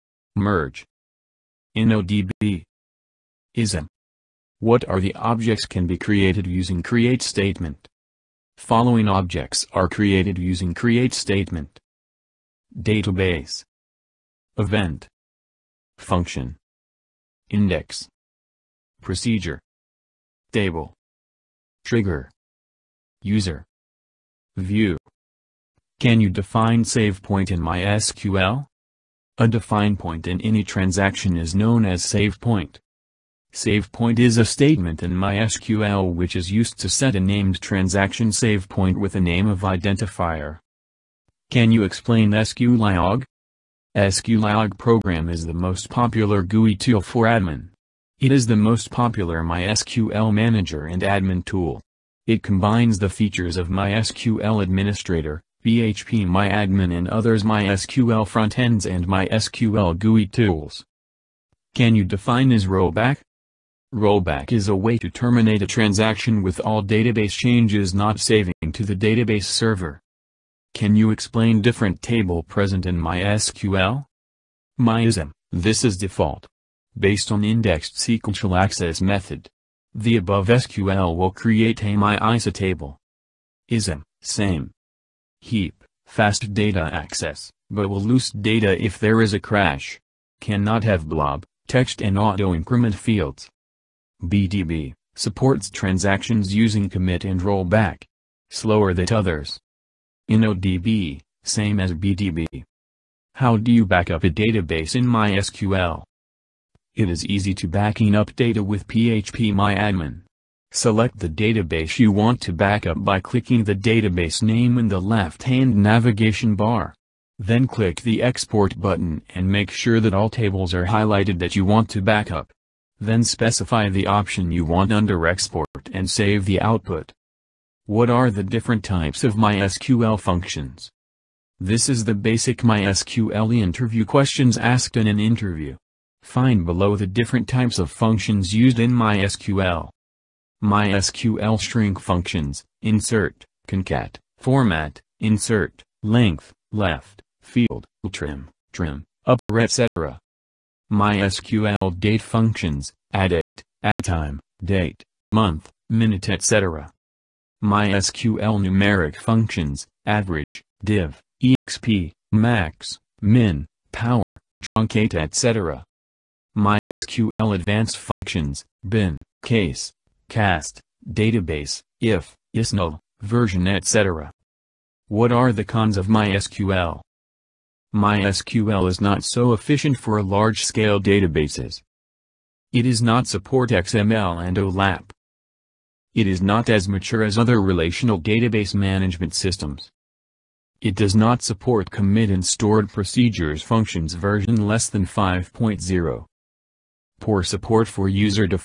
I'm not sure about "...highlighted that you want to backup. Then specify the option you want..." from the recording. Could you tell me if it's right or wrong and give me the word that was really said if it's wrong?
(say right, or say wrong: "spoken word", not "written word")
right.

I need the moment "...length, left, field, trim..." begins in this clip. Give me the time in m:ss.
2:26.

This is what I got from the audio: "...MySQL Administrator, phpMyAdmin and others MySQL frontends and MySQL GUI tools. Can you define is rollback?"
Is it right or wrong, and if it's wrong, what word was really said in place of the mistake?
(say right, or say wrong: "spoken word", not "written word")
right.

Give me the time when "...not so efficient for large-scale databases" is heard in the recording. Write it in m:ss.
2:59.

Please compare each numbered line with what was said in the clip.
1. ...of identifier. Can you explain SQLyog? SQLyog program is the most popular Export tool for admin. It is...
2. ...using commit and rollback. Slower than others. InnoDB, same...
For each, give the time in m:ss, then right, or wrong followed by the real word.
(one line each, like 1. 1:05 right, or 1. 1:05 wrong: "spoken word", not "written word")
1. 0:39 wrong: "GUI", not "Export"
2. 1:36 right.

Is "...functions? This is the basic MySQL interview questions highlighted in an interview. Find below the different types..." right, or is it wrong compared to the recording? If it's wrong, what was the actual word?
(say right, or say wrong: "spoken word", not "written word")
wrong: "asked", not "highlighted".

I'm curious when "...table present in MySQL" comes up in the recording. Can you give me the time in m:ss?
1:12.